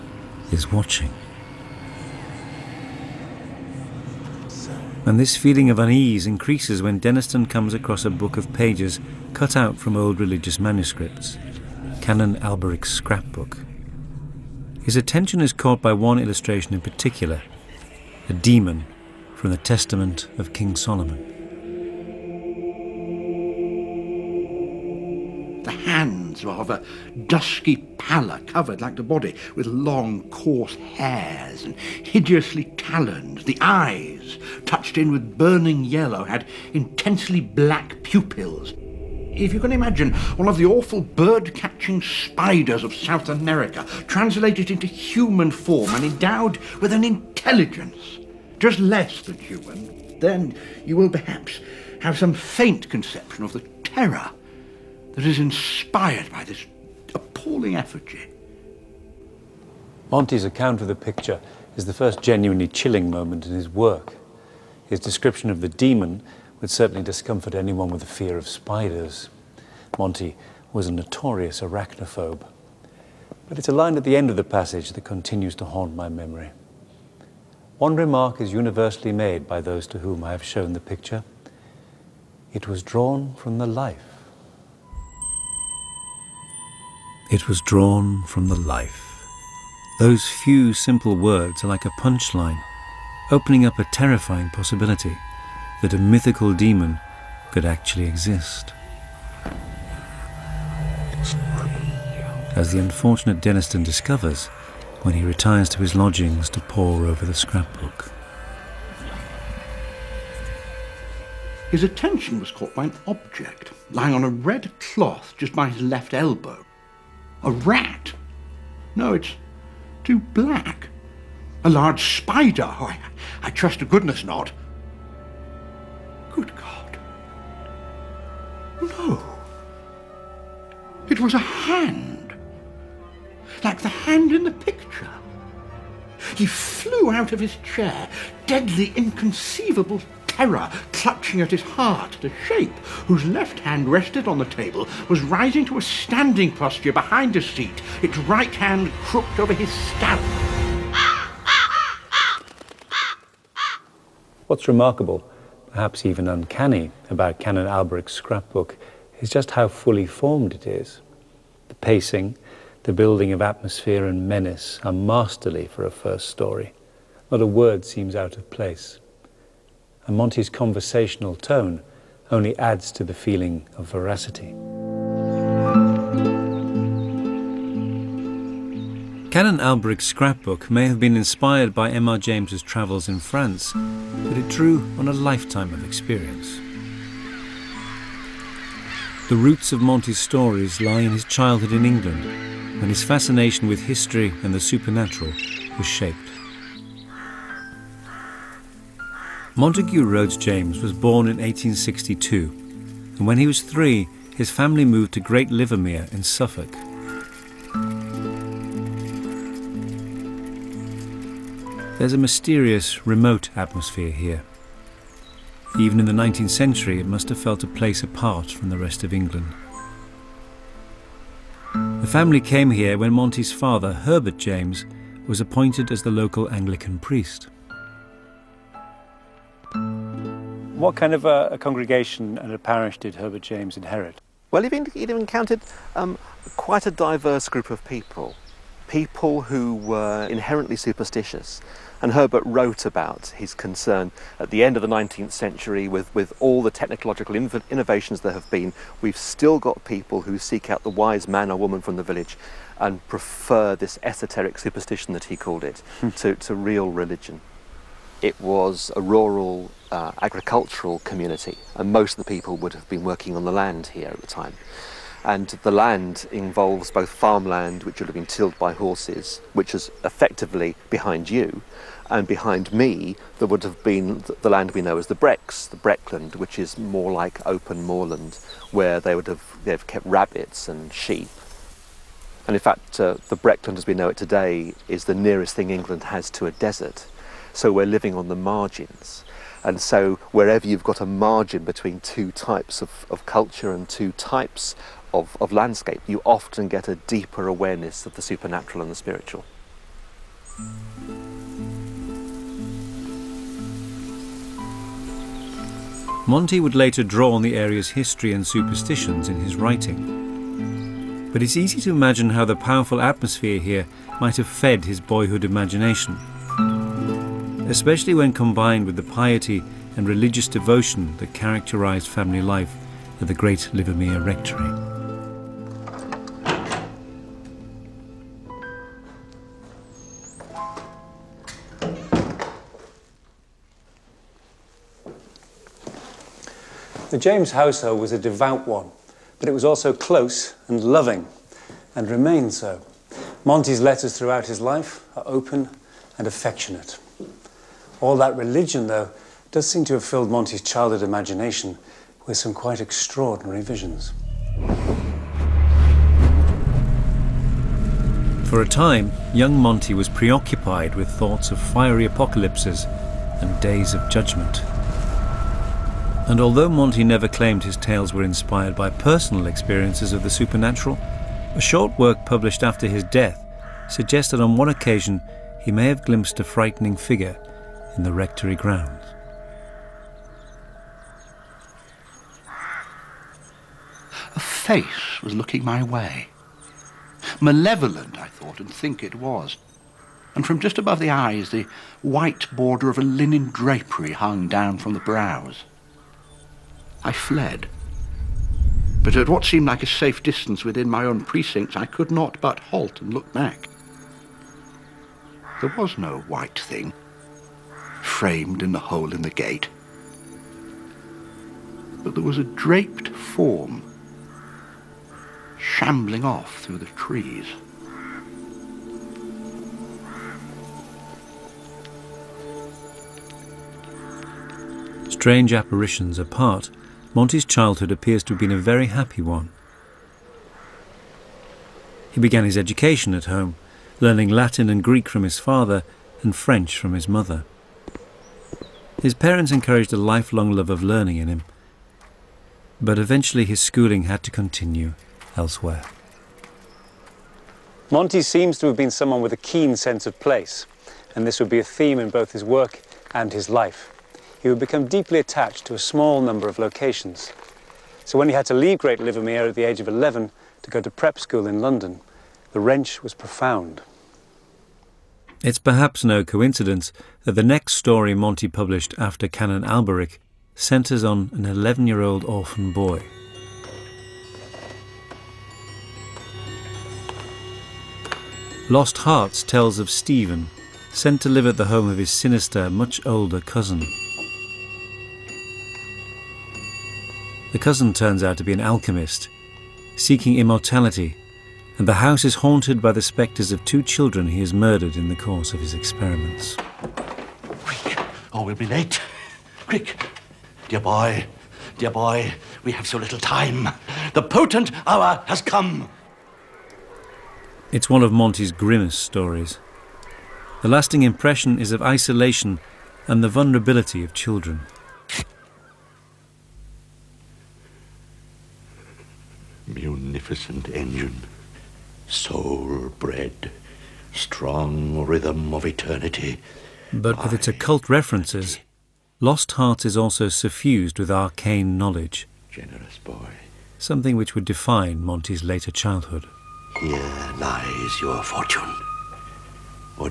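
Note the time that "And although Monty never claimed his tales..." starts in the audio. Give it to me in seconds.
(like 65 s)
366 s.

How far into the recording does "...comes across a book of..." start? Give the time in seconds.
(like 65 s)
7 s.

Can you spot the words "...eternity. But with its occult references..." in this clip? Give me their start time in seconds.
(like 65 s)
525 s.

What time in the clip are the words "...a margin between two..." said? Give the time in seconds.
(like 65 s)
291 s.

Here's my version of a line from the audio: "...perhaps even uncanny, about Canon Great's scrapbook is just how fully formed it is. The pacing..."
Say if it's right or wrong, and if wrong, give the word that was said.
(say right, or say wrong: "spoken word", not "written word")
wrong: "Alberic", not "Great".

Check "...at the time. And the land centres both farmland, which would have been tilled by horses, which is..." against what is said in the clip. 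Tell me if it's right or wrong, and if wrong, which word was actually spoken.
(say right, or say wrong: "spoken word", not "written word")
wrong: "involves", not "centres".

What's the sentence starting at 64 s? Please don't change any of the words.
His description of the demon would certainly discomfort anyone with a fear of spiders.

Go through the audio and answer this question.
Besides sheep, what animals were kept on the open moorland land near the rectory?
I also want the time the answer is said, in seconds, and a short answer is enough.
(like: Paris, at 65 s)
Rabbits, at 280 s.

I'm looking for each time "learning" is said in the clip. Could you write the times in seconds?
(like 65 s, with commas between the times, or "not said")
433 s, 440 s.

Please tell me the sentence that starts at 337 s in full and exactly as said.
The James household was a devout one, but it was also close and loving, and remained so.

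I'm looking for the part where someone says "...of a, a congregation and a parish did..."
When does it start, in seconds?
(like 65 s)
231 s.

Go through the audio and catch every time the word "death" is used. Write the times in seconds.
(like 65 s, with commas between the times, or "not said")
373 s.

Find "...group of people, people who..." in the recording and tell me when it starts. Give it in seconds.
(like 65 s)
237 s.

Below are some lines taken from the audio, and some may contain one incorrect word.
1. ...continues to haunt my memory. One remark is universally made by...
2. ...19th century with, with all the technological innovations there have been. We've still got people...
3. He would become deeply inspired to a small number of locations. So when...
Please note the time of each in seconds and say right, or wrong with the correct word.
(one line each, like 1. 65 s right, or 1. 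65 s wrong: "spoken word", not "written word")
1. 75 s right
2. 244 s right
3. 454 s wrong: "attached", not "inspired".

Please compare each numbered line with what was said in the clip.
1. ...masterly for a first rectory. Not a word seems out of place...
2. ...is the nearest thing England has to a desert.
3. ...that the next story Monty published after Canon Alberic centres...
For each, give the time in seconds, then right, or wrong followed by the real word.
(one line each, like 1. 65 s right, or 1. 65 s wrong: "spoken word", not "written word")
1. 164 s wrong: "story", not "rectory"
2. 284 s right
3. 467 s right.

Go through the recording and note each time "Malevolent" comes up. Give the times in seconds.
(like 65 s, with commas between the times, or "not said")
387 s.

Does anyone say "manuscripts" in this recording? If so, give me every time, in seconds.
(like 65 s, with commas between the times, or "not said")
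10 s.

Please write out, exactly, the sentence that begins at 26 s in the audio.
hands of a dusky pallor covered like the body with long coarse hairs and hideously taloned.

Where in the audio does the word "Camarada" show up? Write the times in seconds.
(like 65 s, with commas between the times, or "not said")
not said.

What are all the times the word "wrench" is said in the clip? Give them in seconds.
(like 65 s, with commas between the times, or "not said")
462 s.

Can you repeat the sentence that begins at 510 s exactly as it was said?
The lasting impression is of isolation and the vulnerability of children.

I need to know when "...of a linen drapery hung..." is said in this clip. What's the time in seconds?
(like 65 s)
392 s.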